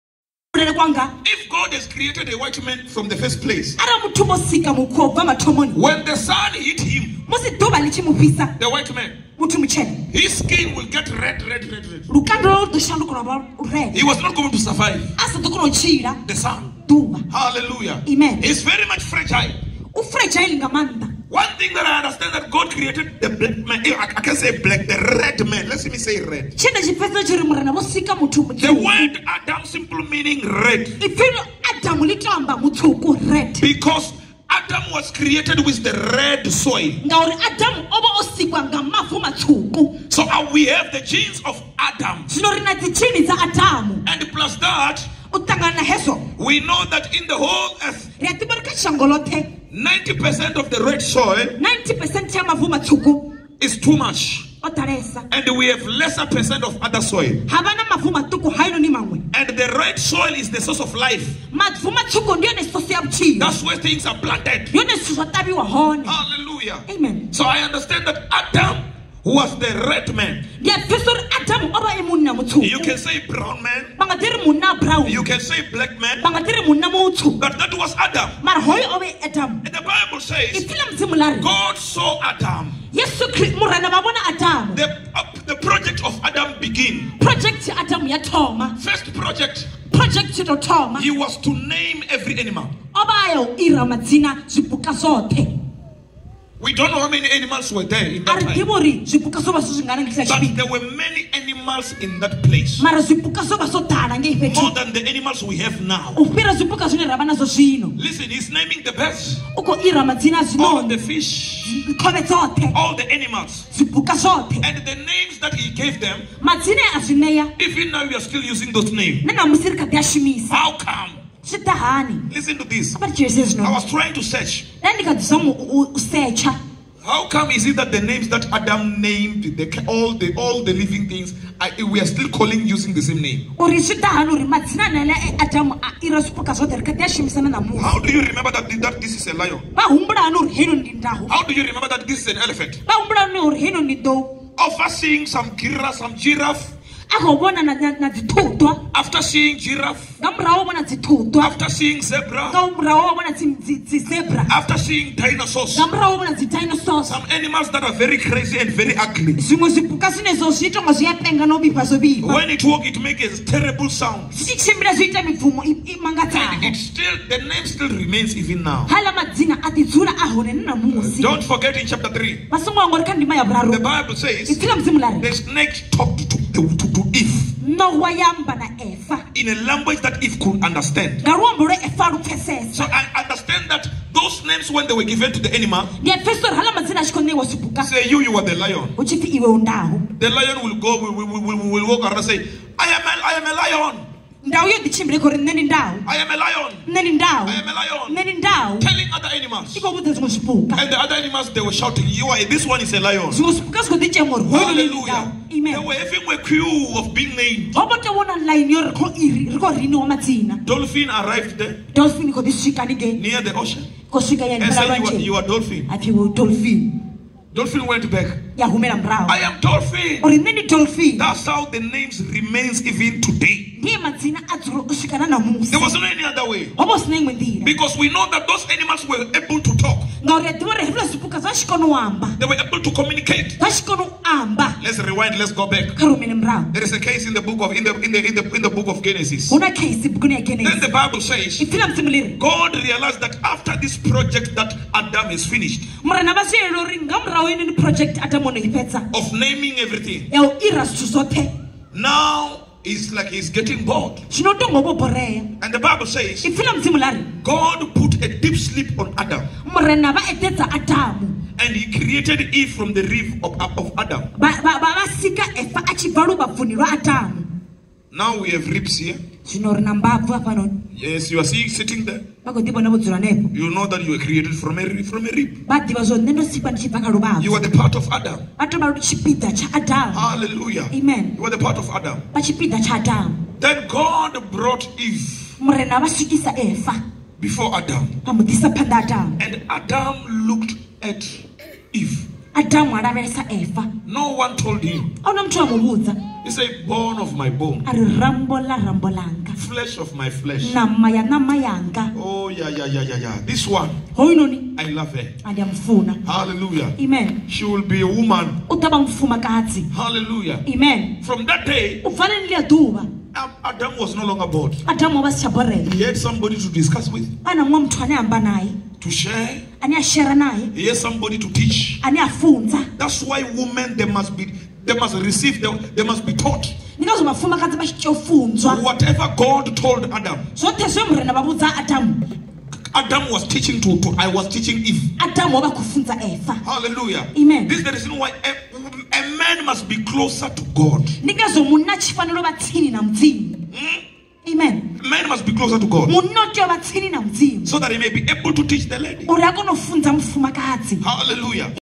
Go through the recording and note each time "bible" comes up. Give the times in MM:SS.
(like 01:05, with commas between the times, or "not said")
01:19, 02:53, 04:00, 04:15.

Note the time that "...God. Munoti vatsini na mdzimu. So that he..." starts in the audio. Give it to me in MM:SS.
05:45.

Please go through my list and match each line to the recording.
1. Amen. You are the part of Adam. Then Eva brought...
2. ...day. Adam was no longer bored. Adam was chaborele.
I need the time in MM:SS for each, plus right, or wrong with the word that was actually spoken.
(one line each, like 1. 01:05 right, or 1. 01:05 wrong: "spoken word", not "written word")
1. 04:40 wrong: "God", not "Eva"
2. 05:11 right.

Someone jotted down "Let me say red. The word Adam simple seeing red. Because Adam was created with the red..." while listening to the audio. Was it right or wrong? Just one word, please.
wrong.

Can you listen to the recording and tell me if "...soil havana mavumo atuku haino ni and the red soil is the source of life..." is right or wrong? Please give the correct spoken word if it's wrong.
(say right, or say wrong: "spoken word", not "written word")
right.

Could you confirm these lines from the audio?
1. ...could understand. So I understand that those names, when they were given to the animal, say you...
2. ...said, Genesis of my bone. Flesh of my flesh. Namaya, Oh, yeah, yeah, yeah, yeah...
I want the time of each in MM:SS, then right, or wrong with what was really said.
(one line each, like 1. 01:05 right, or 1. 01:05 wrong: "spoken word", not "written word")
1. 03:00 right
2. 04:56 wrong: "Bone", not "Genesis".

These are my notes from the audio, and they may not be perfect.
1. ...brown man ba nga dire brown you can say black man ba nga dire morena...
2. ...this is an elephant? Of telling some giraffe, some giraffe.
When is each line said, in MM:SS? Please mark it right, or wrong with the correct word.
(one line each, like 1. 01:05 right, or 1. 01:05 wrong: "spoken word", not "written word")
1. 01:13 wrong: "monna", not "morena"
2. 02:22 wrong: "seeing", not "telling".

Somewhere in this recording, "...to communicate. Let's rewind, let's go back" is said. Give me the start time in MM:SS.
03:52.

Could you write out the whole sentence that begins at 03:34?
And said, you are, you are dolphin.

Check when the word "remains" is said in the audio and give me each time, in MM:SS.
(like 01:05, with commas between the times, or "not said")
02:47, 03:42.